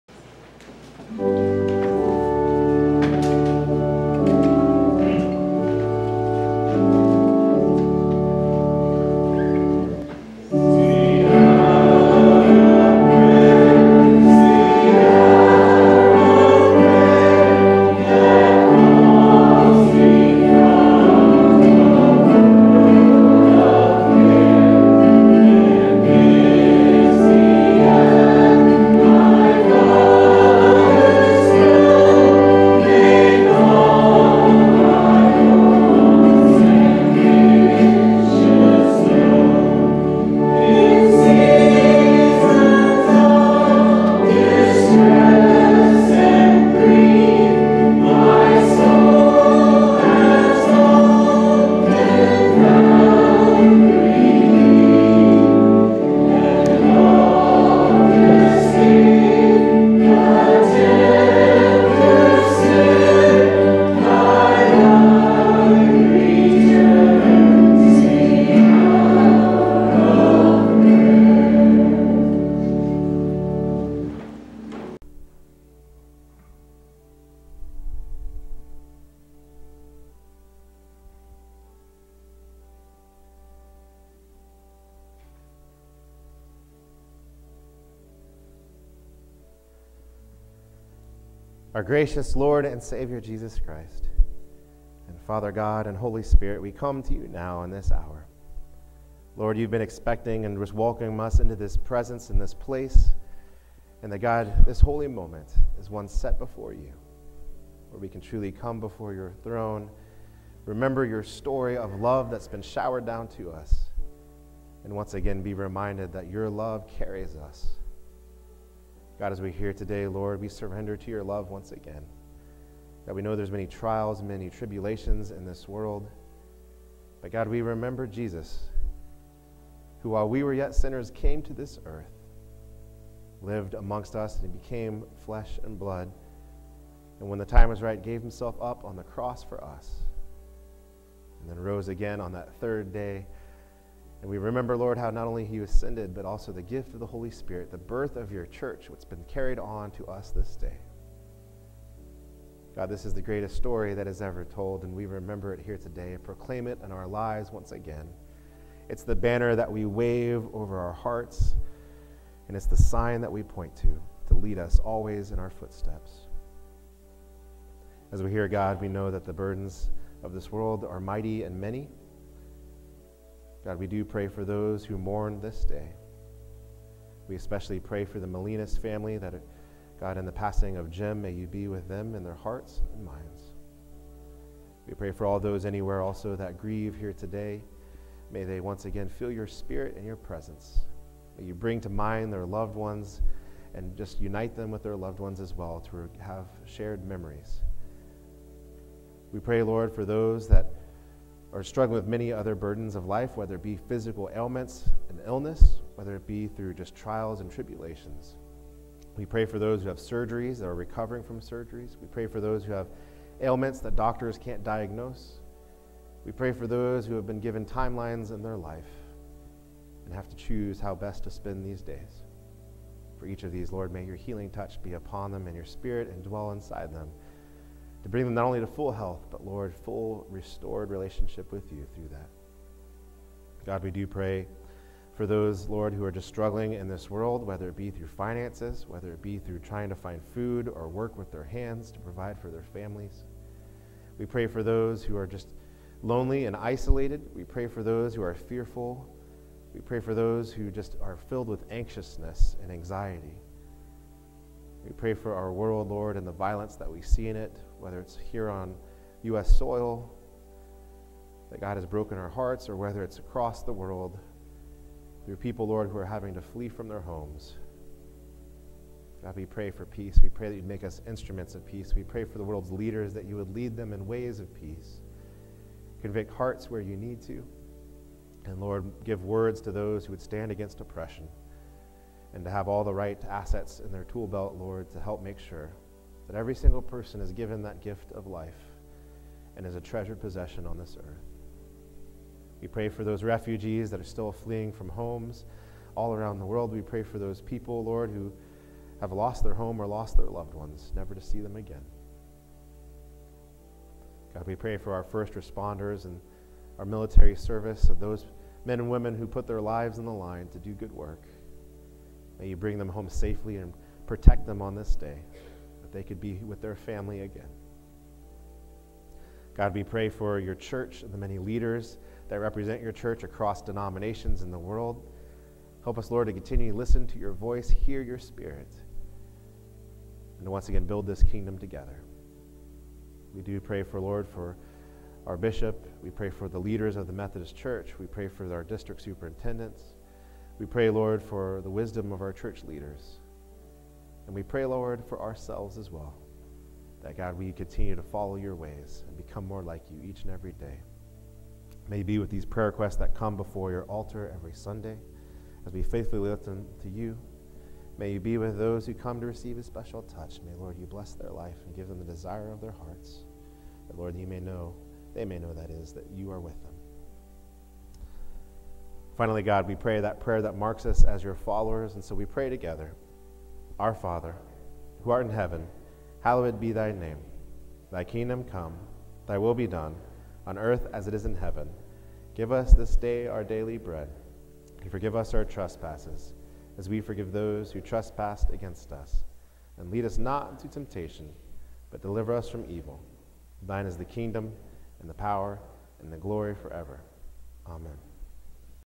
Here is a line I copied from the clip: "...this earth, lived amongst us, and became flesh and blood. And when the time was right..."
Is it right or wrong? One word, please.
right.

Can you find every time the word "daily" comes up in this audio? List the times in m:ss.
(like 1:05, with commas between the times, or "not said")
6:23.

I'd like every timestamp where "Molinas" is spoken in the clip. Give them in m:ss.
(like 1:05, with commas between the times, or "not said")
2:58.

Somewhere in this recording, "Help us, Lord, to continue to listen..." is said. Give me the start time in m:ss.
5:25.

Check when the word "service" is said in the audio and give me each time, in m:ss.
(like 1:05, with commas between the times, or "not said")
5:07.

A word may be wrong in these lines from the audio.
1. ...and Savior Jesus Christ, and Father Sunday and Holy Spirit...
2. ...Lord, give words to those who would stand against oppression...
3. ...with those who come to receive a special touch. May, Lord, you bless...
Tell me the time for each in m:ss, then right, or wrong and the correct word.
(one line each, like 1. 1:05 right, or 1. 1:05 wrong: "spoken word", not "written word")
1. 1:32 wrong: "God", not "Sunday"
2. 4:38 right
3. 5:58 right.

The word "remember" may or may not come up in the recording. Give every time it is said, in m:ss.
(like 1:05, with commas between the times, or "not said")
1:50, 2:07, 2:24, 2:35.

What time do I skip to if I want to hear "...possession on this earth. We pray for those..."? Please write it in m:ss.
4:50.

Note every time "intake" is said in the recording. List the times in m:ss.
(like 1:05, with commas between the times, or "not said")
not said.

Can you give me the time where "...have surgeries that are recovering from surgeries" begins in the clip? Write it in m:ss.
3:29.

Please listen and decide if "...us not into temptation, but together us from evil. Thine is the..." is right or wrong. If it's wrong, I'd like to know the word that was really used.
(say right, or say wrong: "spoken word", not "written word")
wrong: "deliver", not "together".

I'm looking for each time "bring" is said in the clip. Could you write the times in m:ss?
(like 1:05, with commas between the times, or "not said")
3:11, 3:48, 5:12.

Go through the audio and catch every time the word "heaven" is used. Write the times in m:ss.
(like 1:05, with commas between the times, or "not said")
6:15, 6:21.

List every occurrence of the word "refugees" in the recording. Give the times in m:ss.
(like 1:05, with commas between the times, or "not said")
4:53.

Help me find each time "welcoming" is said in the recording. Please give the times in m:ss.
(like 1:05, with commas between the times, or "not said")
1:40.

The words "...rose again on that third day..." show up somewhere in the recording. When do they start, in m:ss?
2:21.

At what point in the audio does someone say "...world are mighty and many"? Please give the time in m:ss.
2:50.